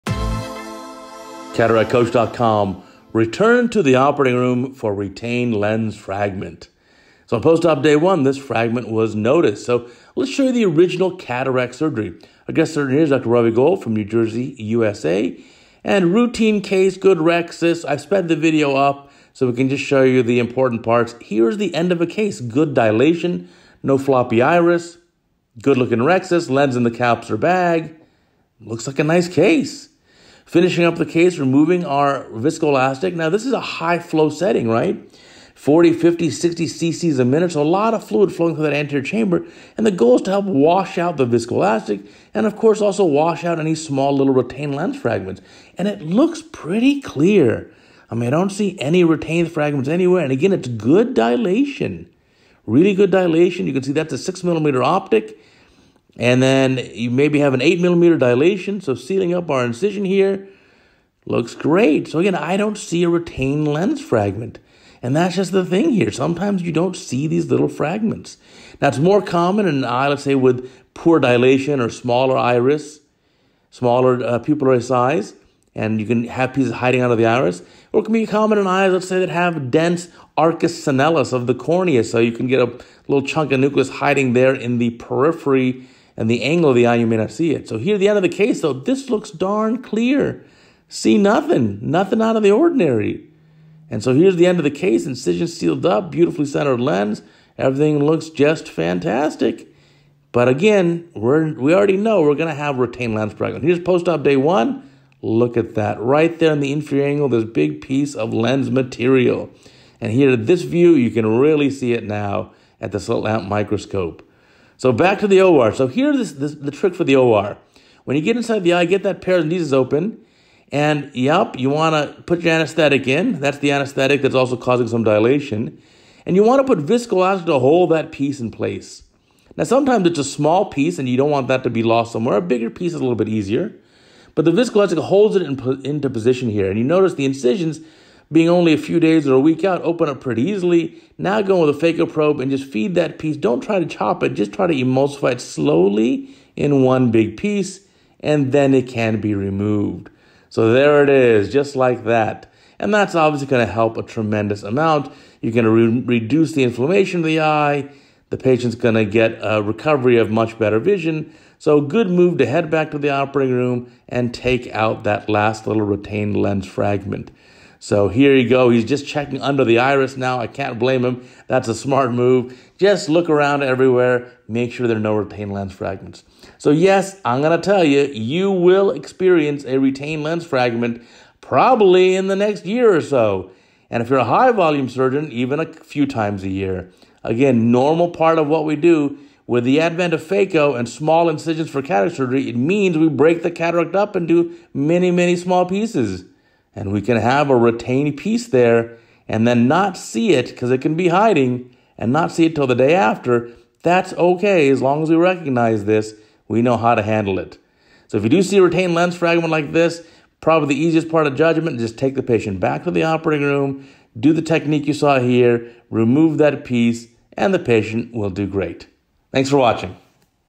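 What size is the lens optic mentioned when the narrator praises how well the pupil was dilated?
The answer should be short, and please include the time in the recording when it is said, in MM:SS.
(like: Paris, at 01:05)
6 millimeter, at 00:54.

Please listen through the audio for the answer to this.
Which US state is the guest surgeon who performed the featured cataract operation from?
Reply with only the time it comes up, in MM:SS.
00:13.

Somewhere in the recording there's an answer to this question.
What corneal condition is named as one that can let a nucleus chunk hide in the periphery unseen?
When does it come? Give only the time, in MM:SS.
01:20.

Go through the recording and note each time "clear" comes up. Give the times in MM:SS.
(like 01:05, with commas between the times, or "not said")
00:46, 01:29.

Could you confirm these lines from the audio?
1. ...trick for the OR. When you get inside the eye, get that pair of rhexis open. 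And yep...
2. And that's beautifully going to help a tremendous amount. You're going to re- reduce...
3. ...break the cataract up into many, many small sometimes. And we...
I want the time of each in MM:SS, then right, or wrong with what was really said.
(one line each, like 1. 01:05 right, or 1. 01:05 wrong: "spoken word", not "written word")
1. 01:56 wrong: "paracentesis", not "rhexis"
2. 02:32 wrong: "obviously", not "beautifully"
3. 03:13 wrong: "pieces", not "sometimes".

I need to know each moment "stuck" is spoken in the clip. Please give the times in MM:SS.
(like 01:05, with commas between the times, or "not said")
not said.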